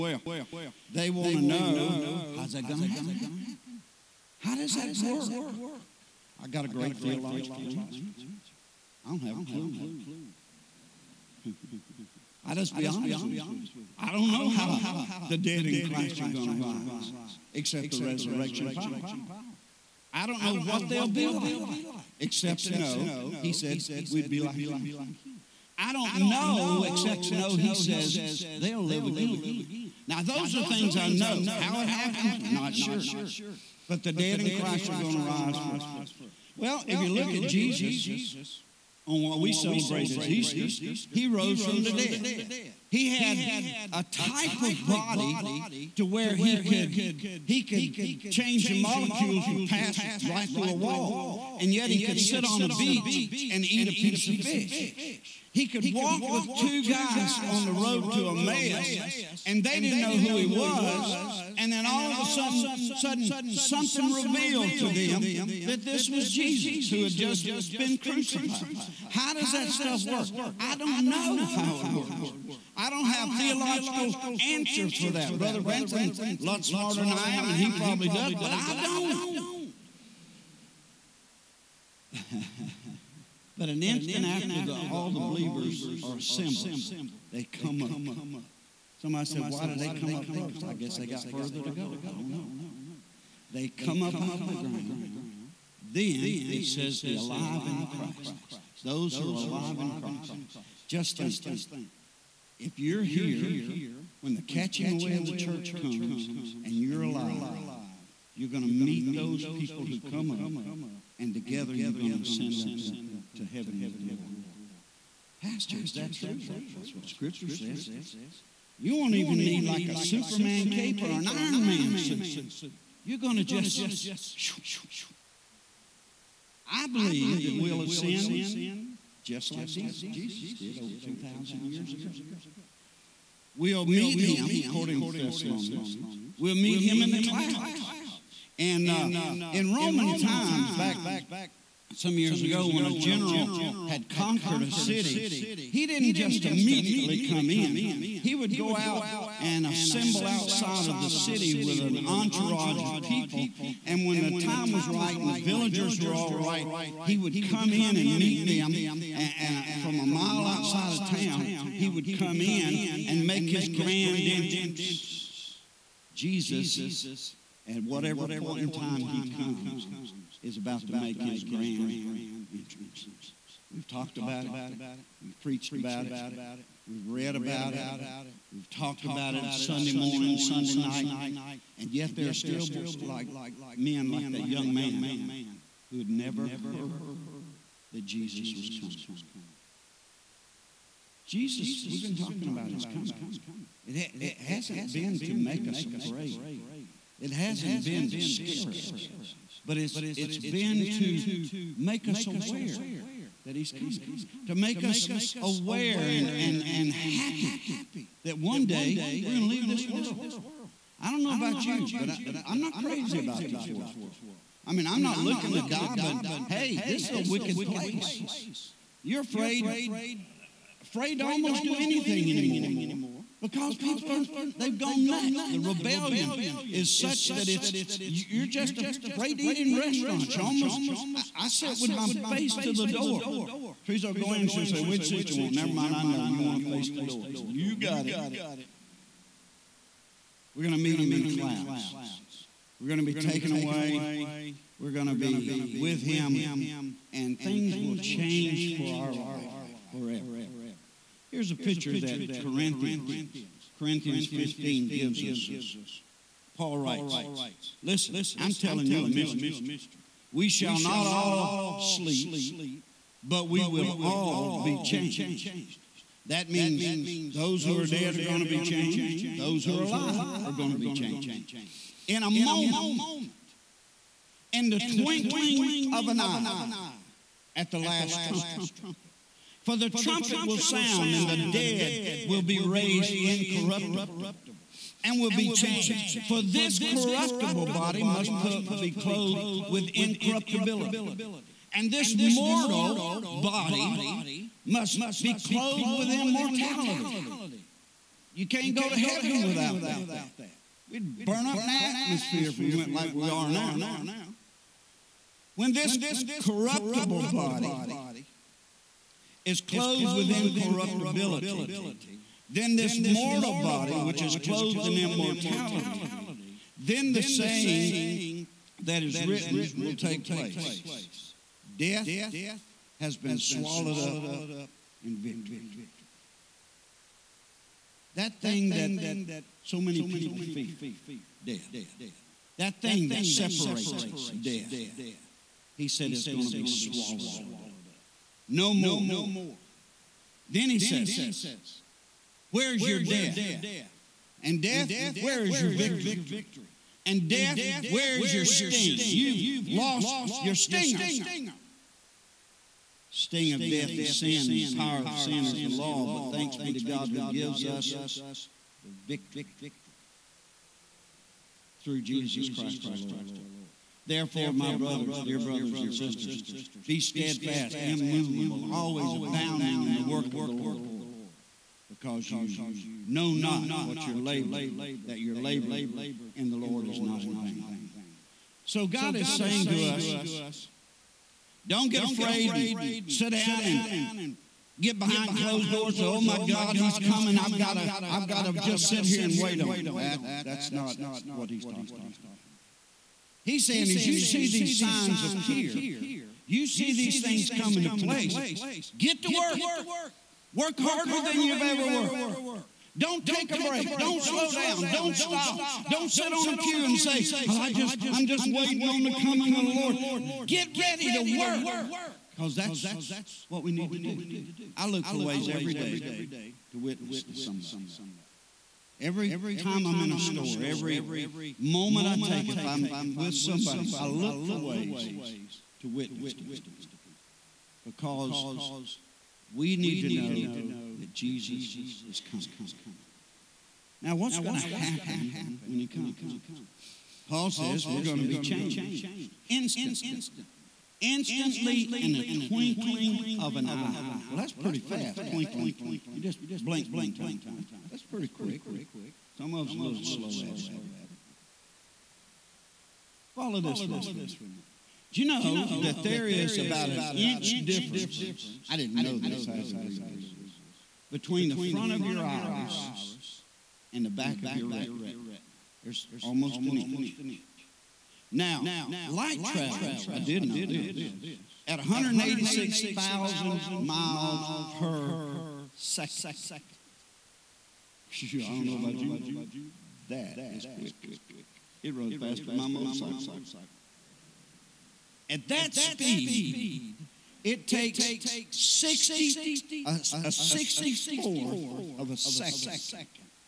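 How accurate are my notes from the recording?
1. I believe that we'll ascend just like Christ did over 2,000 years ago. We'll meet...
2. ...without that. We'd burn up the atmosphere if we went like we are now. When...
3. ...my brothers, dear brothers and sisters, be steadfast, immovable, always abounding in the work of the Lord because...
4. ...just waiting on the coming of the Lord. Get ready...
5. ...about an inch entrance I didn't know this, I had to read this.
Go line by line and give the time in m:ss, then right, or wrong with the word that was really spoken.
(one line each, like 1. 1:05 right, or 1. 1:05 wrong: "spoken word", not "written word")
1. 2:06 wrong: "Jesus", not "Christ"
2. 4:59 right
3. 6:04 right
4. 6:48 right
5. 7:36 wrong: "difference", not "entrance".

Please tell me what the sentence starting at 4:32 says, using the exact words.
In a moment, in the twinkling of an eye, at the last trumpet.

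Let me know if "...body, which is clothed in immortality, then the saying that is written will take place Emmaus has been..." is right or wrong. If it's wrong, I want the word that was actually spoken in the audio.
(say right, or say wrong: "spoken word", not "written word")
wrong: "Death", not "Emmaus".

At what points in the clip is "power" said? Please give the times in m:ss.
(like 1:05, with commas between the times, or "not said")
0:18, 5:54.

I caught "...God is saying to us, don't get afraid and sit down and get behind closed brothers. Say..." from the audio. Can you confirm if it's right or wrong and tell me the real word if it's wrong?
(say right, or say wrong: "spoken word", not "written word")
wrong: "doors", not "brothers".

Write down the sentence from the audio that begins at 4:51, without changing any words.
And this mortal body must be clothed with immortality.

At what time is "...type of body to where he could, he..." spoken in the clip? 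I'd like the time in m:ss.
0:44.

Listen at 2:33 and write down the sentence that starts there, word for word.
And when the time was right and the villagers were all right, he would come in and meet them.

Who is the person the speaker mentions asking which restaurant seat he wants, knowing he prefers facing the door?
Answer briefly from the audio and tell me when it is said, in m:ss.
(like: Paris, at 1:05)
Teresa, at 3:53.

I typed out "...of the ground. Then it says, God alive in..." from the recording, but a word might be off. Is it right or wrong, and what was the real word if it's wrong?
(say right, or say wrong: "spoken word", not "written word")
wrong: "The", not "God".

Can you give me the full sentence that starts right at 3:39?
You're afraid, afraid to almost do anything anymore because people are, they've gone nuts.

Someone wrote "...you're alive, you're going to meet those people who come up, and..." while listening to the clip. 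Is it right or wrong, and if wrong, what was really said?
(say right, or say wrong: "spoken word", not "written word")
right.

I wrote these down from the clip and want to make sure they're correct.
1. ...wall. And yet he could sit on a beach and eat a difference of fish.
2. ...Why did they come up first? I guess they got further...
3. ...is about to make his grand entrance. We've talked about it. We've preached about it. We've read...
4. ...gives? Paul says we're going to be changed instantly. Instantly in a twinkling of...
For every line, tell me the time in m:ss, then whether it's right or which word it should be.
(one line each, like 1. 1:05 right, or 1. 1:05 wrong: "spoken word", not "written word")
1. 0:50 wrong: "piece", not "difference"
2. 1:29 right
3. 2:50 right
4. 7:15 wrong: "comes", not "gives".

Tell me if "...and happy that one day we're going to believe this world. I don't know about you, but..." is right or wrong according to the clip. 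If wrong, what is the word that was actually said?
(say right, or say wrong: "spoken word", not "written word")
wrong: "leave", not "believe".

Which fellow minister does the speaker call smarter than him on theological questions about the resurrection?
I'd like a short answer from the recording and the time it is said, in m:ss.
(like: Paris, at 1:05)
Brother Branson, at 1:15.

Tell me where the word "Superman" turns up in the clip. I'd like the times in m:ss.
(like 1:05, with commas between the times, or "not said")
1:59.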